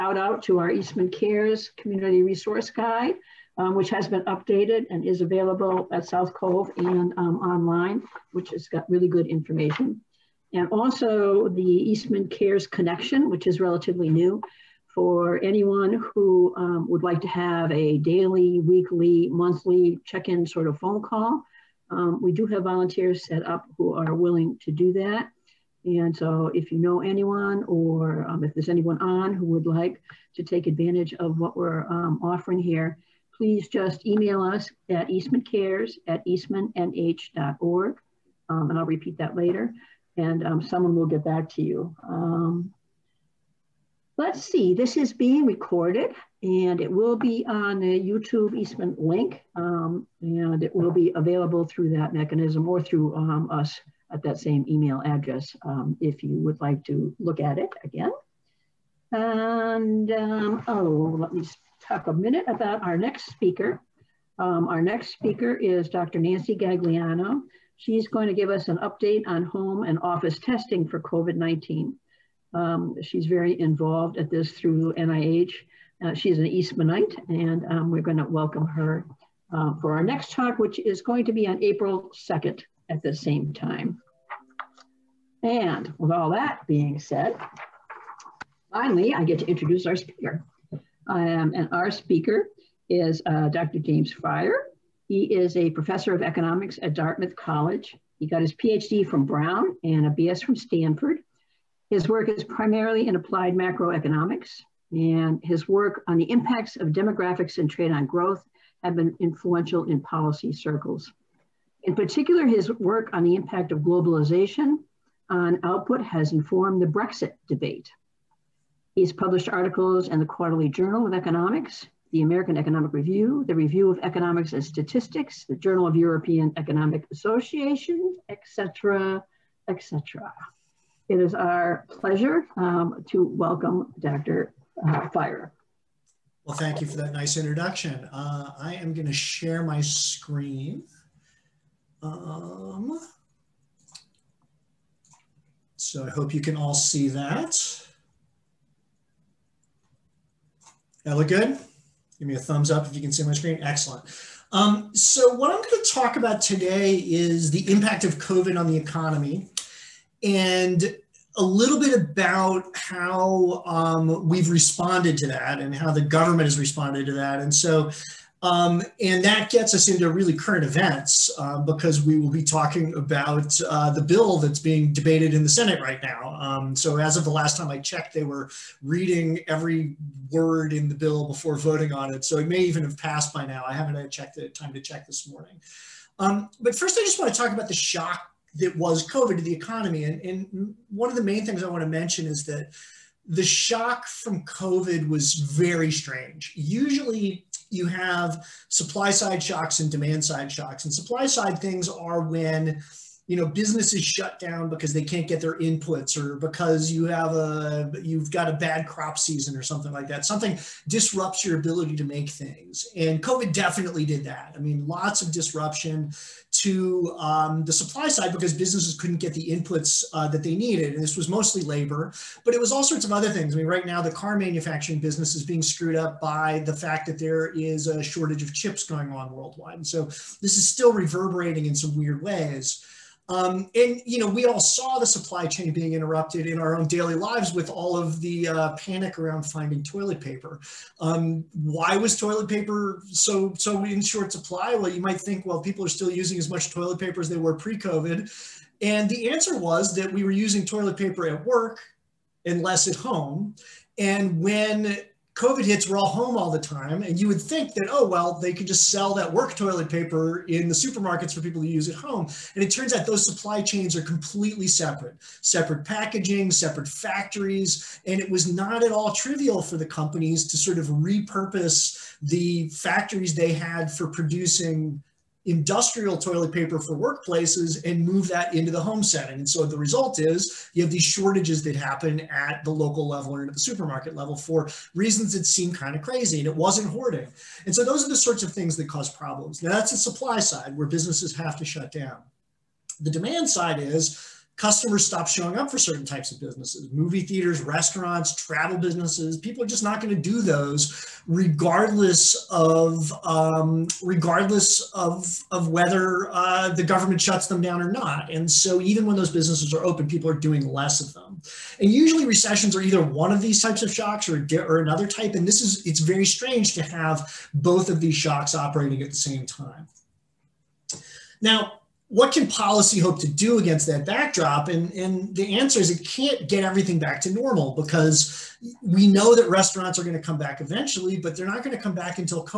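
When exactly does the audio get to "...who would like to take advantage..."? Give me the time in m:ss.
0:29.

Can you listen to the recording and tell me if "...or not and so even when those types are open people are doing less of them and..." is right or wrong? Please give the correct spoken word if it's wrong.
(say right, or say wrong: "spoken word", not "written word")
wrong: "businesses", not "types".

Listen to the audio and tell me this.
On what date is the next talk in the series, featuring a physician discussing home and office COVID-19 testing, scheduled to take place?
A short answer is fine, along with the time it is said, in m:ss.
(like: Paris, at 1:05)
April 2, at 1:21.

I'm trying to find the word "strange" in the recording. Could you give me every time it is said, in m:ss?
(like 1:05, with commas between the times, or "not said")
3:15, 5:16.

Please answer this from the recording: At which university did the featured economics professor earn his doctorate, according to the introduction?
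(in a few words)
Brown.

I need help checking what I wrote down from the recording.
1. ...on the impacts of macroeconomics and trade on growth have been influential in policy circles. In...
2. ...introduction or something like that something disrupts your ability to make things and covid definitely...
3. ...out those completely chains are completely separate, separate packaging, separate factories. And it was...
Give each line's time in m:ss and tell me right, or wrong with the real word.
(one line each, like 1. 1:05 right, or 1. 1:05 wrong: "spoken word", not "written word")
1. 1:46 wrong: "demographics", not "macroeconomics"
2. 3:29 wrong: "season", not "introduction"
3. 4:22 wrong: "supply", not "completely".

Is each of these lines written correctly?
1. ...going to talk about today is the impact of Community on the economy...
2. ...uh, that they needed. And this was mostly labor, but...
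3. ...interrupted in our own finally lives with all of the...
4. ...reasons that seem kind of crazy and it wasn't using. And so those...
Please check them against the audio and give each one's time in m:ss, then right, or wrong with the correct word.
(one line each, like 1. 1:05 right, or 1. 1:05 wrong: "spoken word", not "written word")
1. 2:35 wrong: "COVID", not "Community"
2. 3:40 right
3. 3:55 wrong: "daily", not "finally"
4. 4:44 wrong: "hoarding", not "using".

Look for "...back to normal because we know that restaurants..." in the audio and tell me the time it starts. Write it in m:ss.
5:26.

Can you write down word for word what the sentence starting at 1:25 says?
And with all that being said, finally, I get to introduce our speaker.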